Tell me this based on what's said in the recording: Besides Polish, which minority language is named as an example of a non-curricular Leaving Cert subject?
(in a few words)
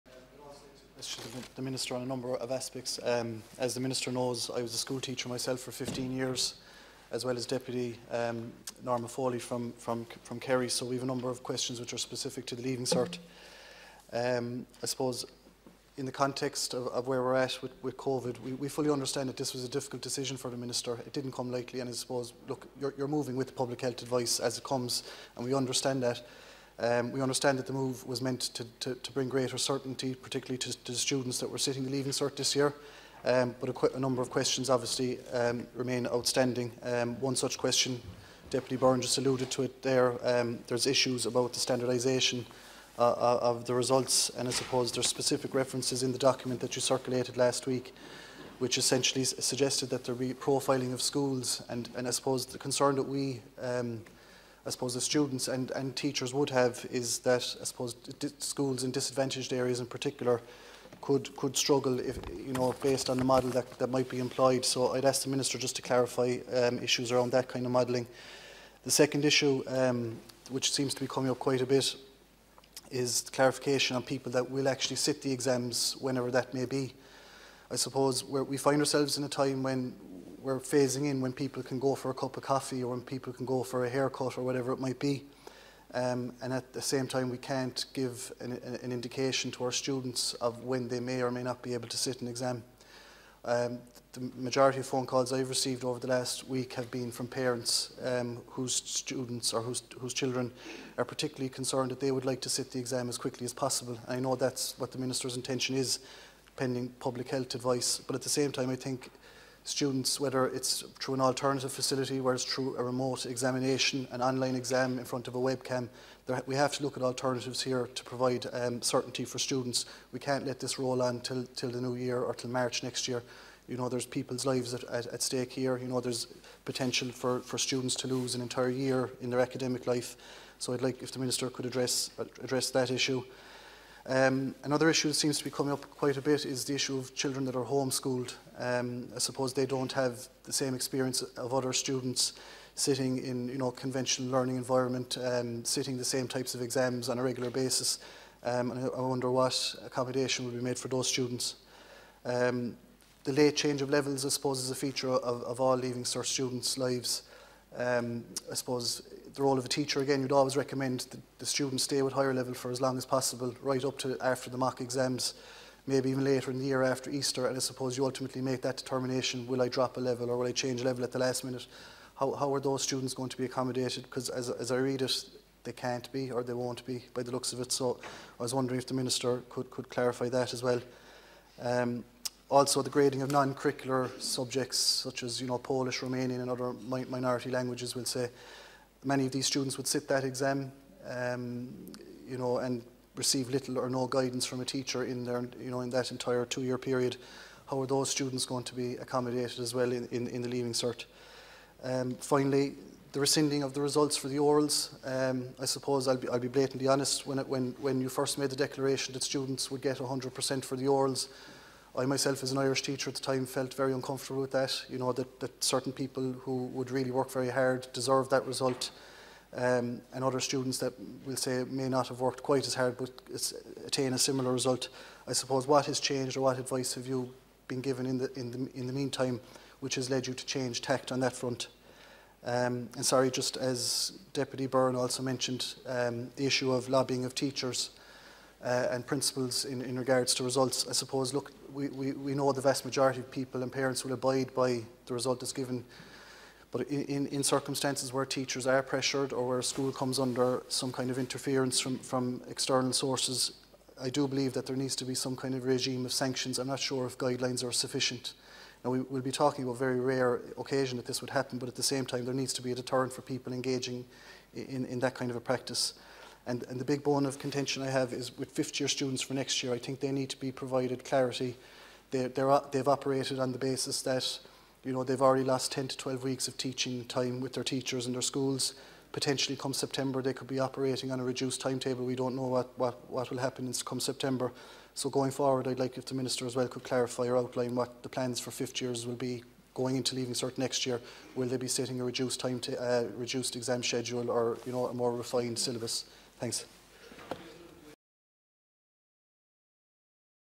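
Romanian.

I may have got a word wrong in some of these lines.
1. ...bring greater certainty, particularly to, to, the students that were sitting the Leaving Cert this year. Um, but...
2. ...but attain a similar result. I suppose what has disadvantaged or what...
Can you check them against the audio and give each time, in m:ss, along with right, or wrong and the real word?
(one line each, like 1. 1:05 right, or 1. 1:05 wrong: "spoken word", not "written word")
1. 0:29 right
2. 3:42 wrong: "changed", not "disadvantaged".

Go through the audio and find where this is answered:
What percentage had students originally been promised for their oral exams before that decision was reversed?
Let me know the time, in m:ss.
3:29.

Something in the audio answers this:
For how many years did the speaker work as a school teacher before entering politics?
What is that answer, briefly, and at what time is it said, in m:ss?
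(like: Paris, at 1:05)
15, at 0:05.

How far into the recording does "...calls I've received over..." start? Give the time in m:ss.
1:35.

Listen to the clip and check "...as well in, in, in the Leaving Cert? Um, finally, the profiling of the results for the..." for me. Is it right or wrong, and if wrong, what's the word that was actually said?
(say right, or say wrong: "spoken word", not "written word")
wrong: "rescinding", not "profiling".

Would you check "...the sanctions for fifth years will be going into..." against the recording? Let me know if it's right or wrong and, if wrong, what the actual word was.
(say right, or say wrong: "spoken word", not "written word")
wrong: "plans", not "sanctions".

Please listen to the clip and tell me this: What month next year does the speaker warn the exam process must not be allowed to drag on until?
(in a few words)
March.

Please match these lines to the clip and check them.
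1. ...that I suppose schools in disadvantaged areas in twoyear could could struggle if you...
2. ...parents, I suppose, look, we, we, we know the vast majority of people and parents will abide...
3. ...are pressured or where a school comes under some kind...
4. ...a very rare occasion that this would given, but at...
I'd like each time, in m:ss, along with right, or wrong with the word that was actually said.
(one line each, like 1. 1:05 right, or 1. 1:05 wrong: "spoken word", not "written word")
1. 0:57 wrong: "particular", not "twoyear"
2. 4:00 wrong: "results", not "parents"
3. 4:08 right
4. 4:19 wrong: "happen", not "given".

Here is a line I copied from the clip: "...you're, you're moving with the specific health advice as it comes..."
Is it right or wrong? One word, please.
wrong.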